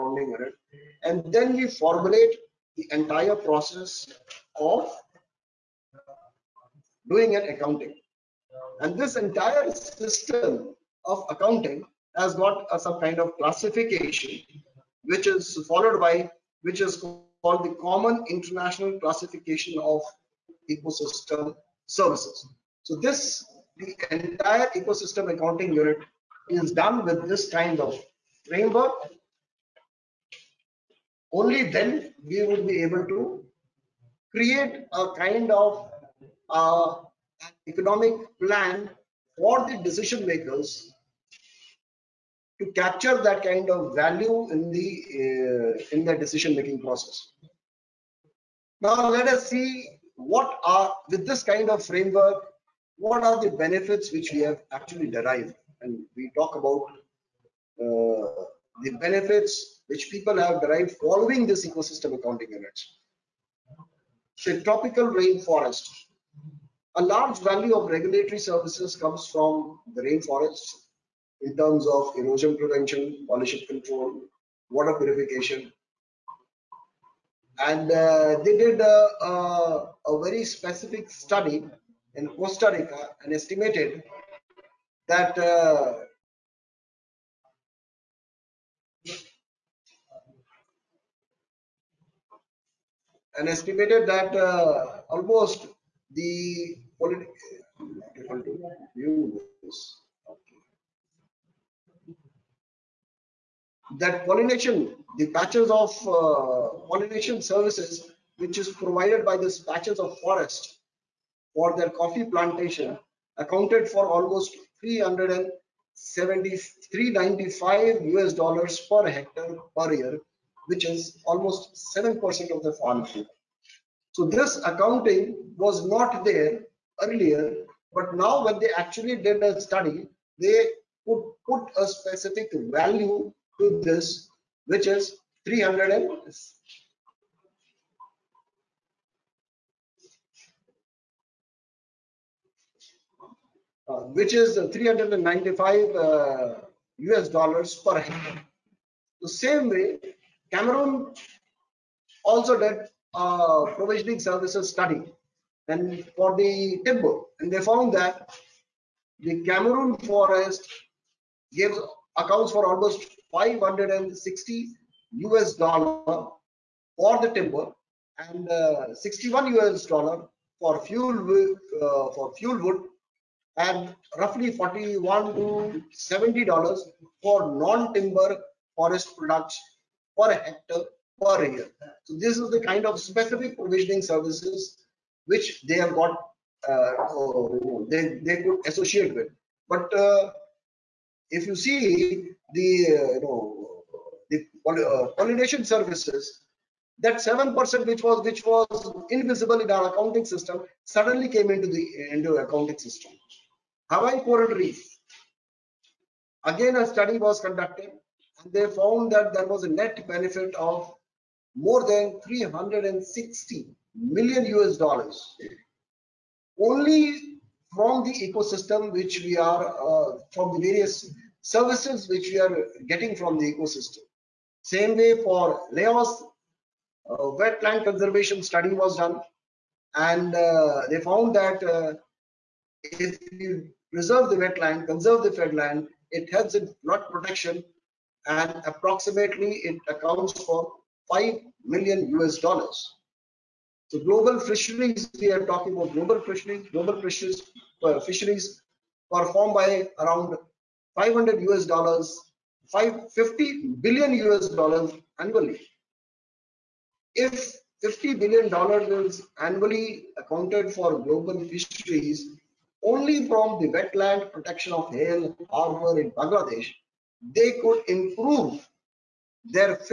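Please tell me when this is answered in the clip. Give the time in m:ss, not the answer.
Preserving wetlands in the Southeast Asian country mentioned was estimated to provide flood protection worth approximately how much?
4:01.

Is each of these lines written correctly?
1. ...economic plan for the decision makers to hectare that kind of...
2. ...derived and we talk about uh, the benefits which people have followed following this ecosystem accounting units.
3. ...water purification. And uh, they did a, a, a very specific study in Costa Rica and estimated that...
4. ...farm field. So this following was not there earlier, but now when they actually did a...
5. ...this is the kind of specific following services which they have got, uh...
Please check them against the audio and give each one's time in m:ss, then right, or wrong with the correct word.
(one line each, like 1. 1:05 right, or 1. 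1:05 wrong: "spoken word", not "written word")
1. 0:37 wrong: "capture", not "hectare"
2. 0:55 wrong: "derived", not "followed"
3. 1:14 right
4. 2:02 wrong: "accounting", not "following"
5. 3:02 wrong: "provisioning", not "following".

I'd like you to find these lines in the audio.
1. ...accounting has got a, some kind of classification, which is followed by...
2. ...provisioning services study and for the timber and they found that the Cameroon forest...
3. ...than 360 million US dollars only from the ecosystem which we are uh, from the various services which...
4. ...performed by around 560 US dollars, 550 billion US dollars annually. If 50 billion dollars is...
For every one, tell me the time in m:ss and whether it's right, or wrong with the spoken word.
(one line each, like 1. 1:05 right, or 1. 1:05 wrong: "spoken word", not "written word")
1. 0:11 right
2. 2:33 right
3. 3:31 right
4. 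4:09 wrong: "500", not "560".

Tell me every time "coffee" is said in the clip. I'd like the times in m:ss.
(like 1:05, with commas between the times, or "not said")
1:51.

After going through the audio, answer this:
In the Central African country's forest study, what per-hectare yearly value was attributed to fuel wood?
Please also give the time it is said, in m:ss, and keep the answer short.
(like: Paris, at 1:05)
61 US dollars, at 2:48.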